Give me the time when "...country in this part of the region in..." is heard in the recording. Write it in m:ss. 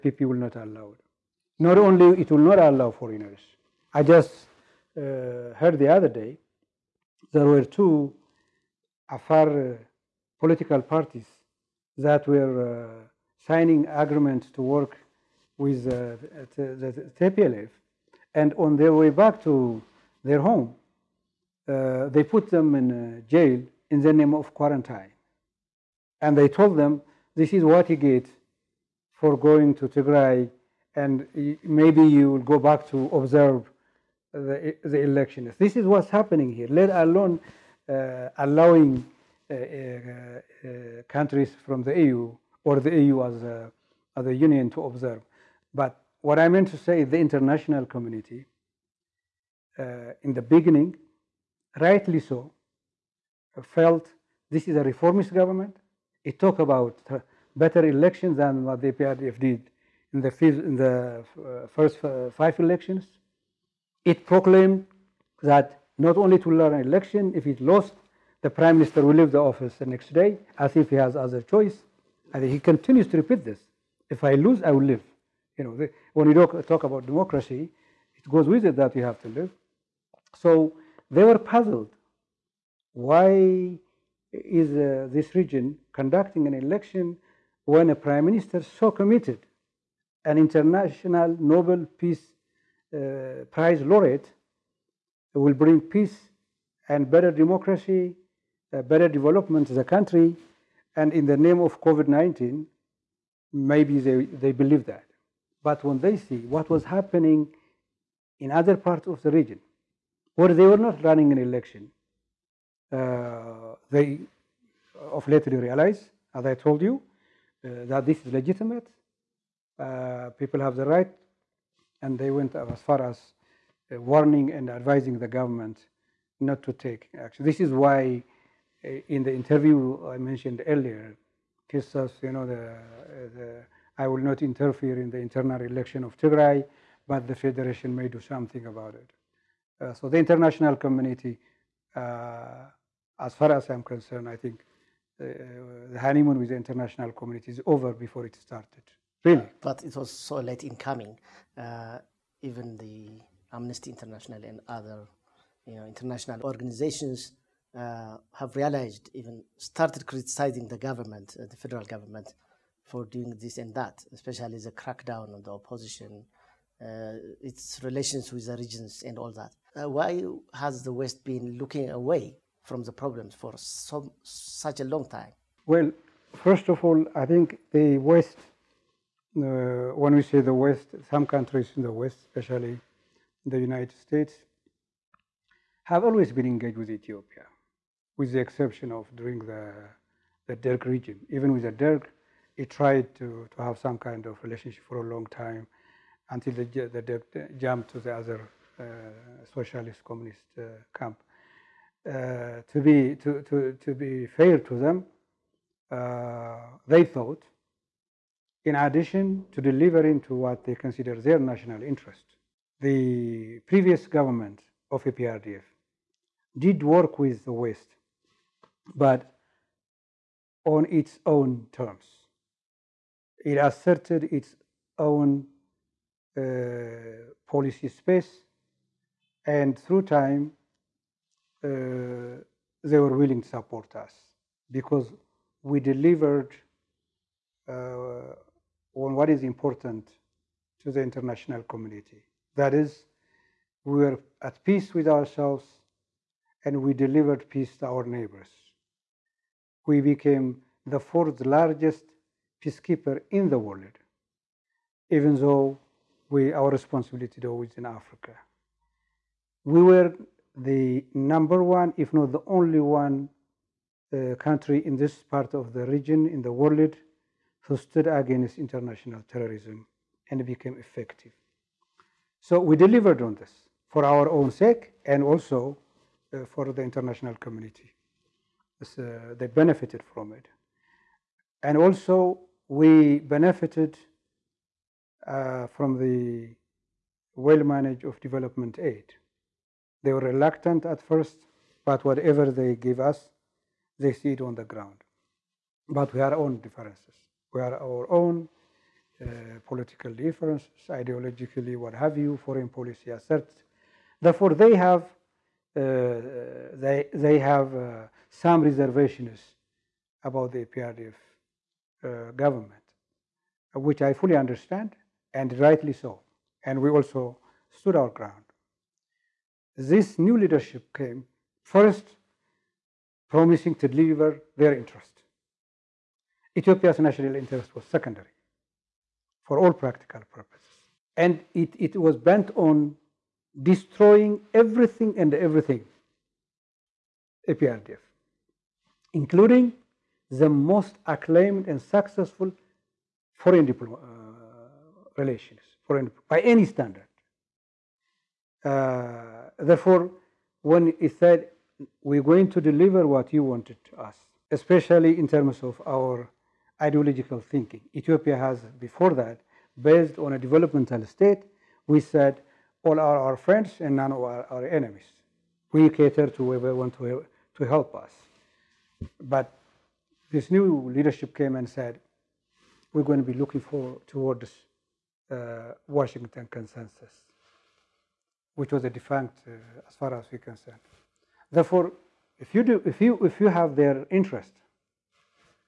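4:24.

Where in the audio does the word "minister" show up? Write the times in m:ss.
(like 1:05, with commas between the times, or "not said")
1:08, 1:28.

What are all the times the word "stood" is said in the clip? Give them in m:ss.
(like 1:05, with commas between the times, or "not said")
4:27, 5:17.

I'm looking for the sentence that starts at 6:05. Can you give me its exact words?
We cater to whoever wants to, to help us.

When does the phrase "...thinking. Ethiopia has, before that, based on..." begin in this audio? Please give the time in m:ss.
5:57.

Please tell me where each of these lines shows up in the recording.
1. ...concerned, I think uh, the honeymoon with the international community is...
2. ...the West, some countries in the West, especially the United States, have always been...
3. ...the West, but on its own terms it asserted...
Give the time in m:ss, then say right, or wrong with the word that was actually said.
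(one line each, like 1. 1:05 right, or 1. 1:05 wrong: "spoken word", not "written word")
1. 2:23 right
2. 3:00 right
3. 3:37 right.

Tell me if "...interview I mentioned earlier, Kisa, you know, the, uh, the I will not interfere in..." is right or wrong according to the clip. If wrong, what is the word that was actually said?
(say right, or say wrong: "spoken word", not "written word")
right.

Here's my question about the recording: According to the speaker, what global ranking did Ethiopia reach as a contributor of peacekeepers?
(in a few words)
fourth largest.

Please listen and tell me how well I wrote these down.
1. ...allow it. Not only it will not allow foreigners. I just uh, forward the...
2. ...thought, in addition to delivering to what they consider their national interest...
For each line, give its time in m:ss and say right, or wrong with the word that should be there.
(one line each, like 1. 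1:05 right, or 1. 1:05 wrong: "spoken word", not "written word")
1. 0:00 wrong: "heard", not "forward"
2. 3:27 right.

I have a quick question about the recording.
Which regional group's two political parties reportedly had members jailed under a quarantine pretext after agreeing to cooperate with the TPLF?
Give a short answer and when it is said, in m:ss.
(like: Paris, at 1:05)
Afar, at 0:09.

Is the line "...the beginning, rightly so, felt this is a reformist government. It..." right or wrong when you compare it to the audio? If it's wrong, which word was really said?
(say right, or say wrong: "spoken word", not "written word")
right.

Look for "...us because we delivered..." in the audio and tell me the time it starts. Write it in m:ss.
3:53.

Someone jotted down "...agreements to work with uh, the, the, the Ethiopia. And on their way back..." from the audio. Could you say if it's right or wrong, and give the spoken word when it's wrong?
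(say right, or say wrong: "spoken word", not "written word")
wrong: "TPLF", not "Ethiopia".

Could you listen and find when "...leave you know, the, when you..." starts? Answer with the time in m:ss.
1:14.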